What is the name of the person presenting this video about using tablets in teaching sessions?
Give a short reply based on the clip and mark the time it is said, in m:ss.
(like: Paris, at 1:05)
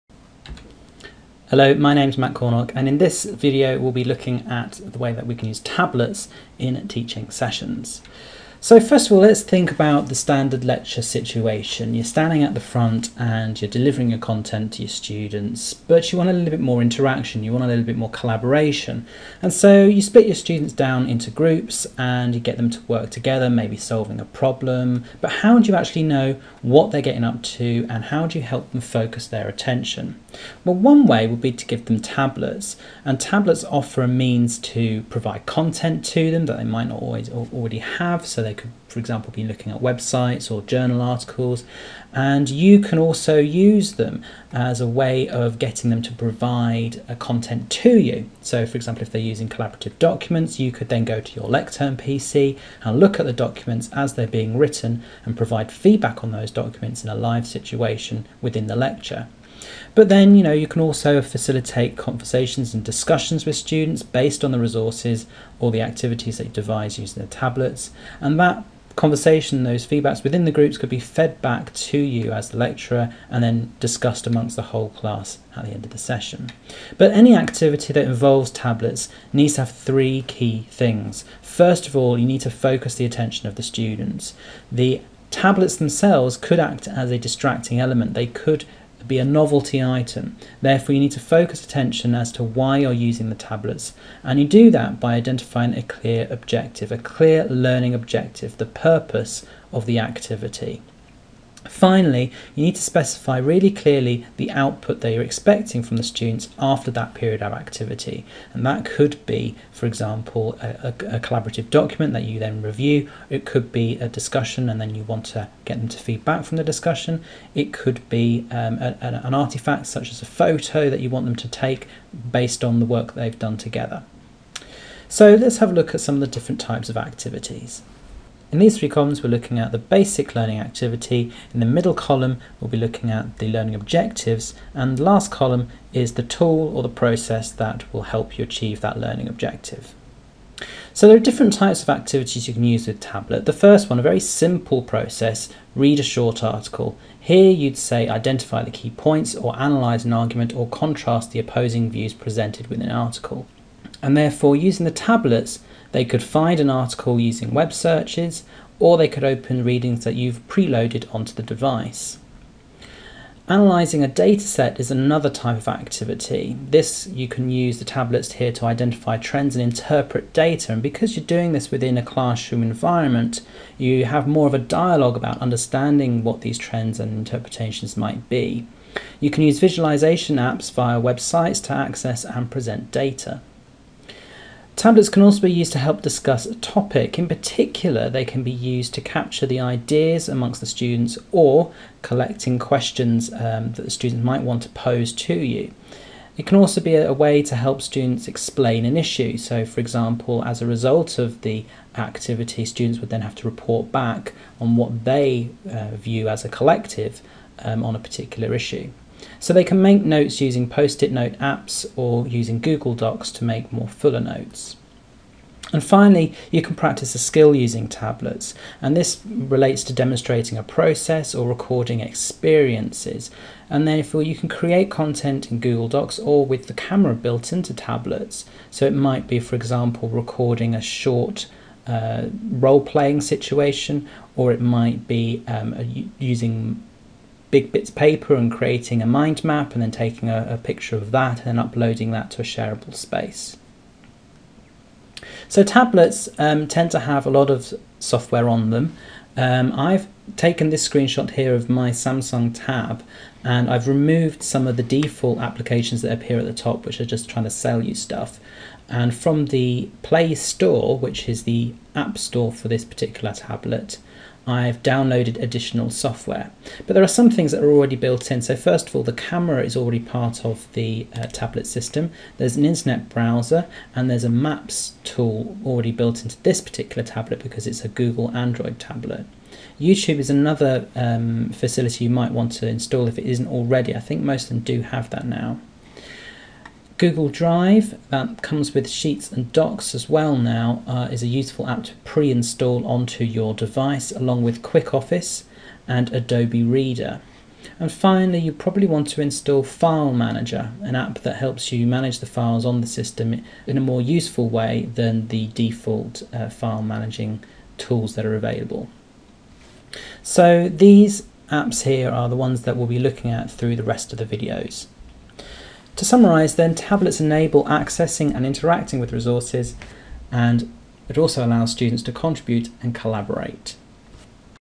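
Matt Cornock, at 0:02.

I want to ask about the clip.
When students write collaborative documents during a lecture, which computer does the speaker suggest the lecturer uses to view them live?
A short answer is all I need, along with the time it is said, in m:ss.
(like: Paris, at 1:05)
Lectern PC, at 0:51.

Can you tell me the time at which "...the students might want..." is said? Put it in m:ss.
3:13.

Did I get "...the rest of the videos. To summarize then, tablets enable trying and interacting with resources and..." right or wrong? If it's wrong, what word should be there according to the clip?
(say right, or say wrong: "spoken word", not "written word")
wrong: "accessing", not "trying".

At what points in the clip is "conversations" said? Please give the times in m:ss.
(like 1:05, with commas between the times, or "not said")
1:01, 1:08.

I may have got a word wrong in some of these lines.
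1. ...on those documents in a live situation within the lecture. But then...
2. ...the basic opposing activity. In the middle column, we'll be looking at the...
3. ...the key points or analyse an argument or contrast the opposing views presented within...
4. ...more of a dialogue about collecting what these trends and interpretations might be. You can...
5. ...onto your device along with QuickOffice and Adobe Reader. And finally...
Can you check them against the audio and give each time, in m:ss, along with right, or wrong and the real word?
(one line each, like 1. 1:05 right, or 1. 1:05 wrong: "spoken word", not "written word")
1. 0:56 right
2. 2:09 wrong: "learning", not "opposing"
3. 2:28 right
4. 2:54 wrong: "understanding", not "collecting"
5. 4:52 right.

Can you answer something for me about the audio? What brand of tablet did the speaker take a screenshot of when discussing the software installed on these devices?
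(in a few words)
Samsung.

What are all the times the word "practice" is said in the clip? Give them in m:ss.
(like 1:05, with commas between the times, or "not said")
3:36.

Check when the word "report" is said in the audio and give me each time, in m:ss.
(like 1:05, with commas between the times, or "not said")
3:23.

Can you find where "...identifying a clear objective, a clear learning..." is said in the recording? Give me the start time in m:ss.
1:35.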